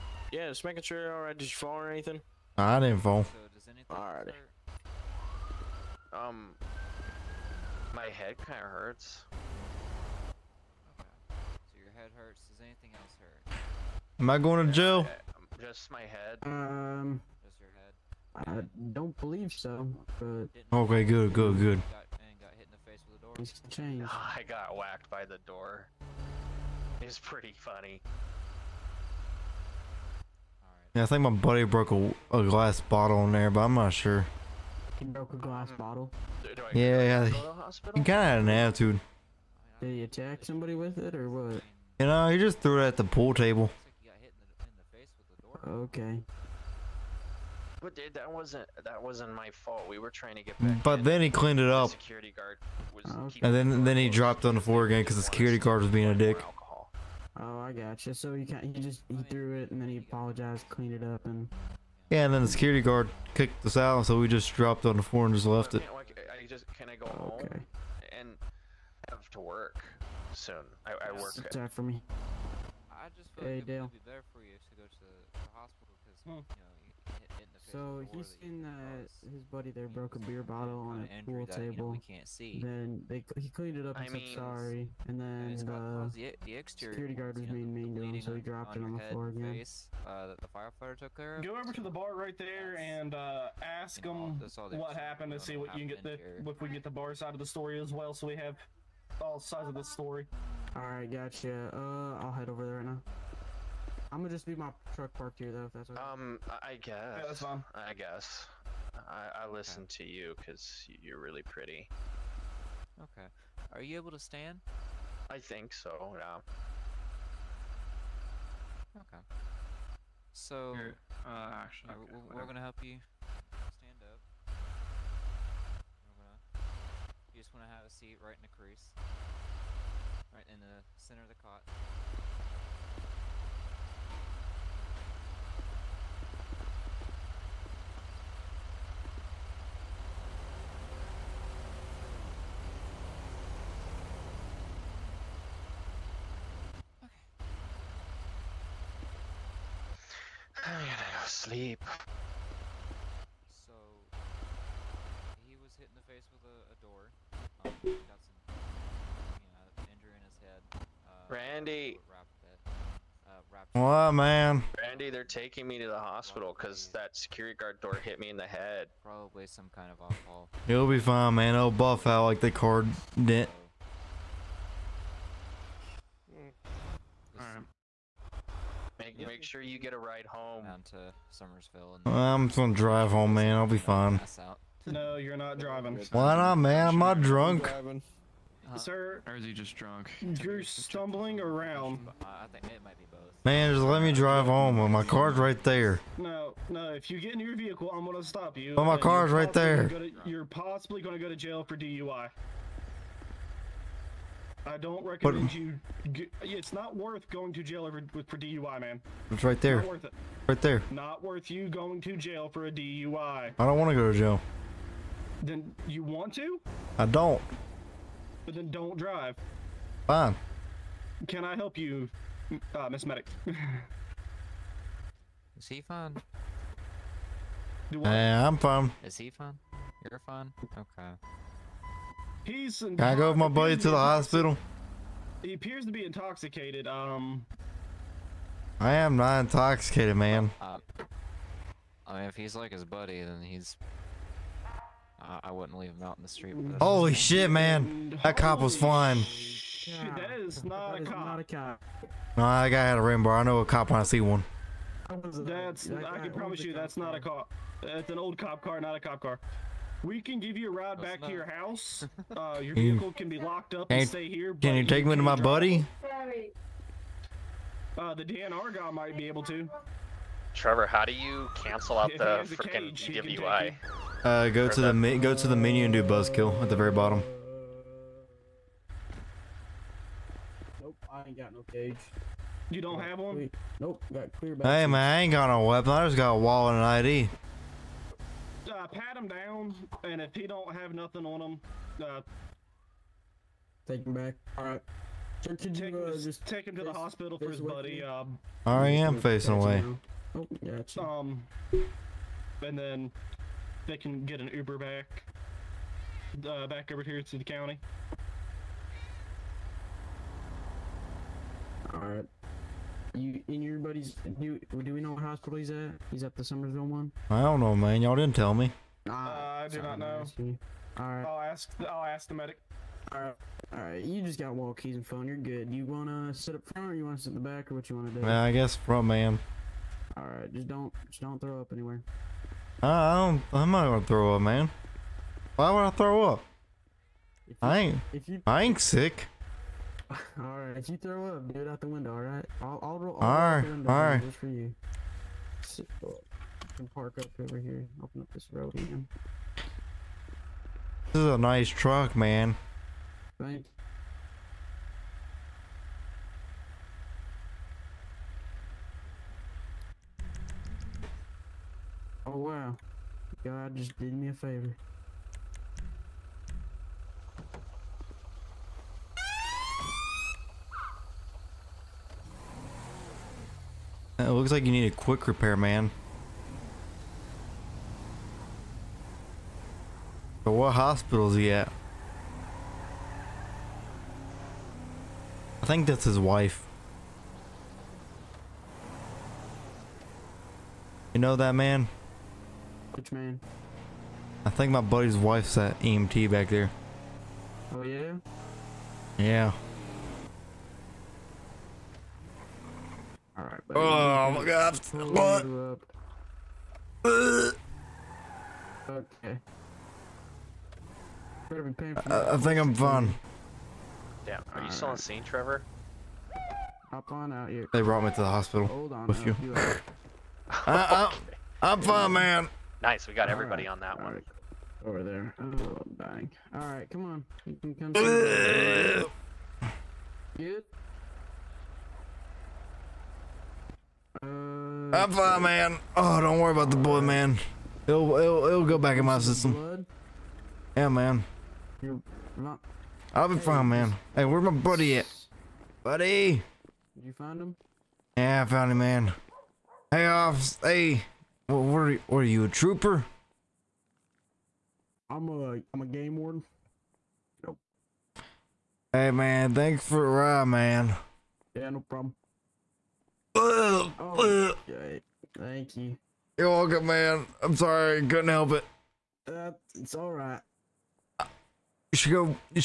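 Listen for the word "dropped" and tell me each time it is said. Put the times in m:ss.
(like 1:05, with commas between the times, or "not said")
0:54, 1:04, 1:28.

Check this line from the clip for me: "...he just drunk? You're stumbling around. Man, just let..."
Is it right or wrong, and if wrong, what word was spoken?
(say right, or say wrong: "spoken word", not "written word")
right.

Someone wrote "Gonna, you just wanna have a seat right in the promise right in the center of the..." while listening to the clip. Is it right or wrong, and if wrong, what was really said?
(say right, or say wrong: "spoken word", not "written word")
wrong: "crease", not "promise".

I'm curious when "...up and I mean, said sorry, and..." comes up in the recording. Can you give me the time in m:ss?
1:23.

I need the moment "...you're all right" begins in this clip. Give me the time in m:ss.
0:01.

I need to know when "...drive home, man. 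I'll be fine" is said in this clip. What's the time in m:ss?
3:02.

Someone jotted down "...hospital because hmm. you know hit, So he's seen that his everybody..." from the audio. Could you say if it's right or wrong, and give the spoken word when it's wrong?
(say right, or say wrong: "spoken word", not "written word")
wrong: "buddy", not "everybody".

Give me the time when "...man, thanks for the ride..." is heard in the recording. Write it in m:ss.
7:39.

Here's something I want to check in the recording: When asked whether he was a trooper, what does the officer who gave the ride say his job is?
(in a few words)
game warden.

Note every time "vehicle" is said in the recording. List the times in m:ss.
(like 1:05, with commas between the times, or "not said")
3:17, 4:22.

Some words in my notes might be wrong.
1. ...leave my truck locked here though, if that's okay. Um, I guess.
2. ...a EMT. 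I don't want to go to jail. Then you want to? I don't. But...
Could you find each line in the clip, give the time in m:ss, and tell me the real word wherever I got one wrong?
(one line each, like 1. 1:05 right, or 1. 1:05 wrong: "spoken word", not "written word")
1. 1:44 wrong: "parked", not "locked"
2. 3:32 wrong: "DUI", not "EMT".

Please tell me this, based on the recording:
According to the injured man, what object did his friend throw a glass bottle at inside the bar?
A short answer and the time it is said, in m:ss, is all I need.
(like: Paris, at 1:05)
pool table, at 0:43.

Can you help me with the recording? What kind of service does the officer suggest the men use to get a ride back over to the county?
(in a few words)
Uber.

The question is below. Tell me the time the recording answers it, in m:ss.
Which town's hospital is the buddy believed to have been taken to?
5:16.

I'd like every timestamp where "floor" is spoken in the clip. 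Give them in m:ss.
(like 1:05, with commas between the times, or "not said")
0:54, 1:05, 1:29.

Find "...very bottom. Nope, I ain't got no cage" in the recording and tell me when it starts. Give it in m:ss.
4:36.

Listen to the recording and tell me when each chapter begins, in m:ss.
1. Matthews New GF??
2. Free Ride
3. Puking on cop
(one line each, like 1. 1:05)
1. 1:45
2. 4:30
3. 7:05.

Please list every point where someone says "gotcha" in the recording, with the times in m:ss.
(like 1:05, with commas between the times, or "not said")
0:57, 1:41.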